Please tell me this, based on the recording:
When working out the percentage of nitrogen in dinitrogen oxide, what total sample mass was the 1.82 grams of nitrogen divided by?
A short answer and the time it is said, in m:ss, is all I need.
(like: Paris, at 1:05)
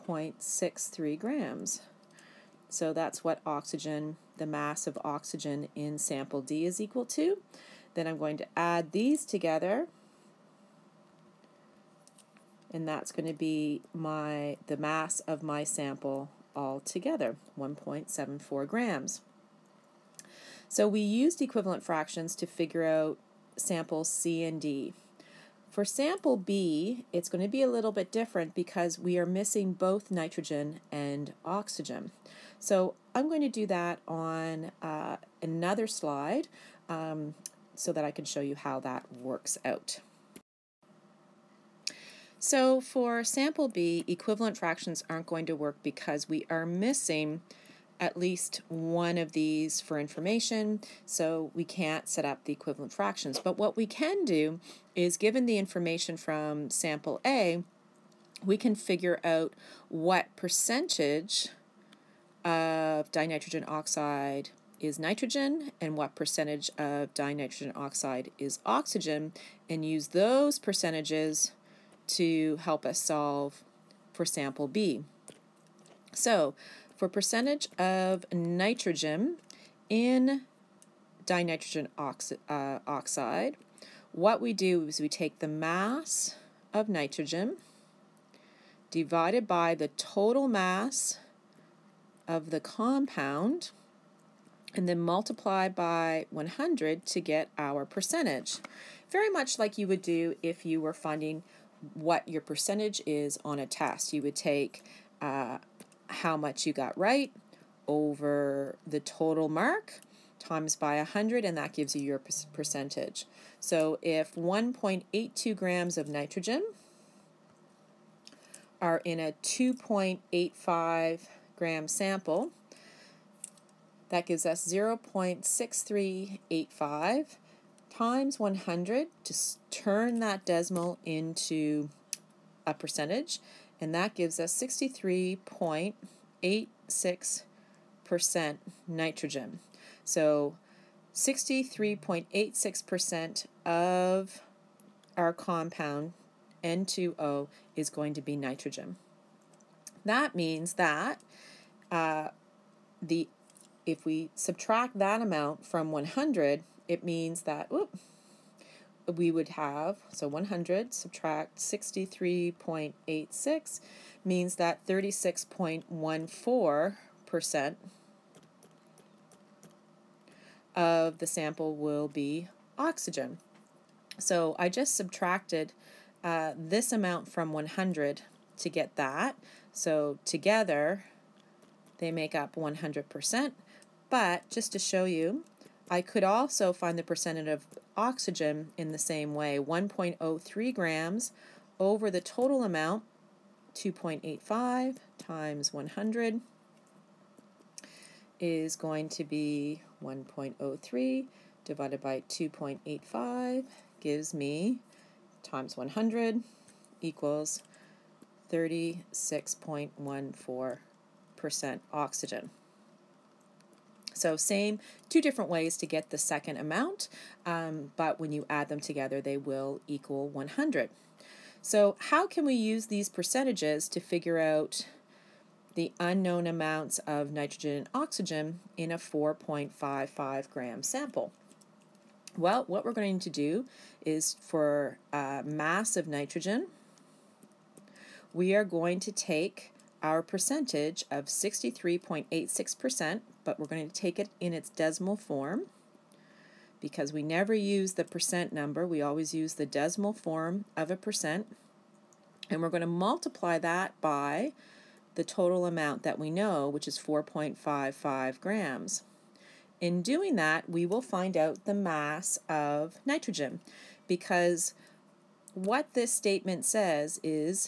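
2.85 grams, at 1:59.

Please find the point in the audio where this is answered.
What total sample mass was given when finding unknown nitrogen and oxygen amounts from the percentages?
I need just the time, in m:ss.
3:48.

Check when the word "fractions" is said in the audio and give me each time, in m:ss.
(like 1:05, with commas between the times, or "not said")
0:21, 0:44, 0:52.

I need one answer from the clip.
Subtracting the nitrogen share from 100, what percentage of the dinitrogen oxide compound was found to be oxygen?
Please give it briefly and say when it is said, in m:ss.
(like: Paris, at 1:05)
36.14%, at 2:44.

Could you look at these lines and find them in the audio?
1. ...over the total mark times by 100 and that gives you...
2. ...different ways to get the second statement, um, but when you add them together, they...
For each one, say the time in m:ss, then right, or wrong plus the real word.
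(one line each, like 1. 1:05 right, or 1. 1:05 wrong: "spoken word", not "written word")
1. 1:47 right
2. 3:35 wrong: "amount", not "statement".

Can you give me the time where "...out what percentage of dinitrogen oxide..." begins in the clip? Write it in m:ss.
0:59.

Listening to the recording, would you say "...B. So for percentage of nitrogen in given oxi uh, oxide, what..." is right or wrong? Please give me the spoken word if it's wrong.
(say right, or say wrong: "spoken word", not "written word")
wrong: "dinitrogen", not "given".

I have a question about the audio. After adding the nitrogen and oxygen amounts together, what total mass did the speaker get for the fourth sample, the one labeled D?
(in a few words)
1.74 grams.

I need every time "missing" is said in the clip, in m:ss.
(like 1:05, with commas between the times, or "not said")
0:29, 0:46.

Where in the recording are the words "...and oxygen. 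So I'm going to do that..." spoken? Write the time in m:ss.
0:30.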